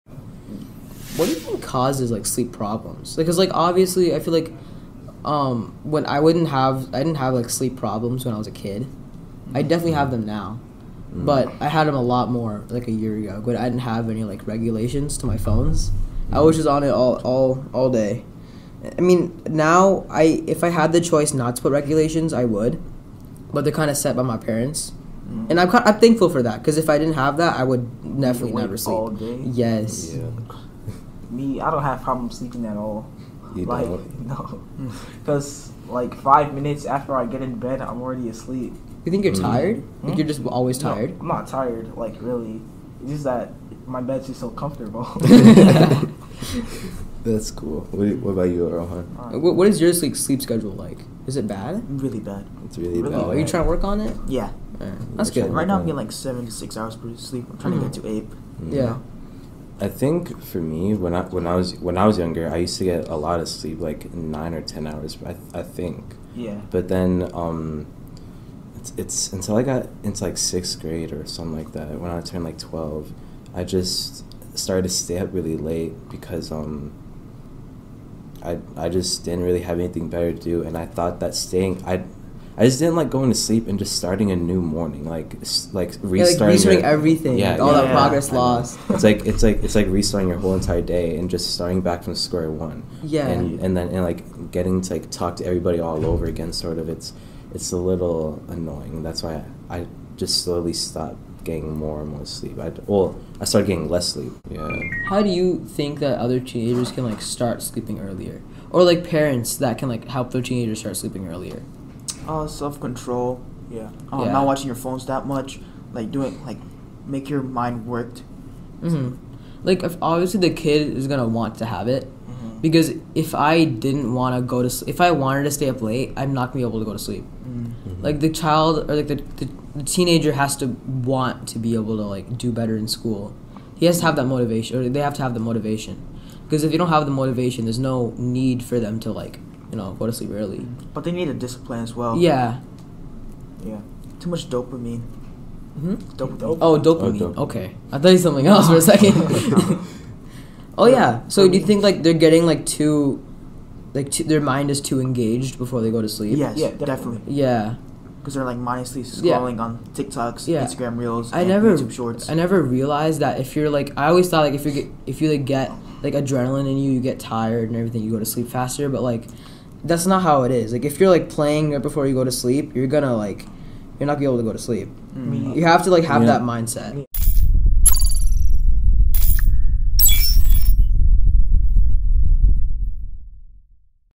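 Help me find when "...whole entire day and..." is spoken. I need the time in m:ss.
1:30.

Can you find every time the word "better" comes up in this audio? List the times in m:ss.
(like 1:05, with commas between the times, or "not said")
1:20, 2:12.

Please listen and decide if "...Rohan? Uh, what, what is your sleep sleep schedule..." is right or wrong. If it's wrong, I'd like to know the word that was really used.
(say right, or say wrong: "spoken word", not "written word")
right.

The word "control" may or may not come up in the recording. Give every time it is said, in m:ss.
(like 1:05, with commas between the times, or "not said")
1:52.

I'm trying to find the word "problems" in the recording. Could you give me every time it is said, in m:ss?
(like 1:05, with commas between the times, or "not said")
0:02, 0:07, 0:32.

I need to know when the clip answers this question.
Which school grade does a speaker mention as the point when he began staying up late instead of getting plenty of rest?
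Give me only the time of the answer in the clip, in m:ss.
1:10.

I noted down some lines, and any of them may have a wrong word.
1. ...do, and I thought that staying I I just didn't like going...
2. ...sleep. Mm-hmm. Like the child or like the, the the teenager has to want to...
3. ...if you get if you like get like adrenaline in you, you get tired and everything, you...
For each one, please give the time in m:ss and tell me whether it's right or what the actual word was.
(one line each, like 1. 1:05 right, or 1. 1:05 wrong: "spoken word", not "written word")
1. 1:20 right
2. 2:06 right
3. 2:44 right.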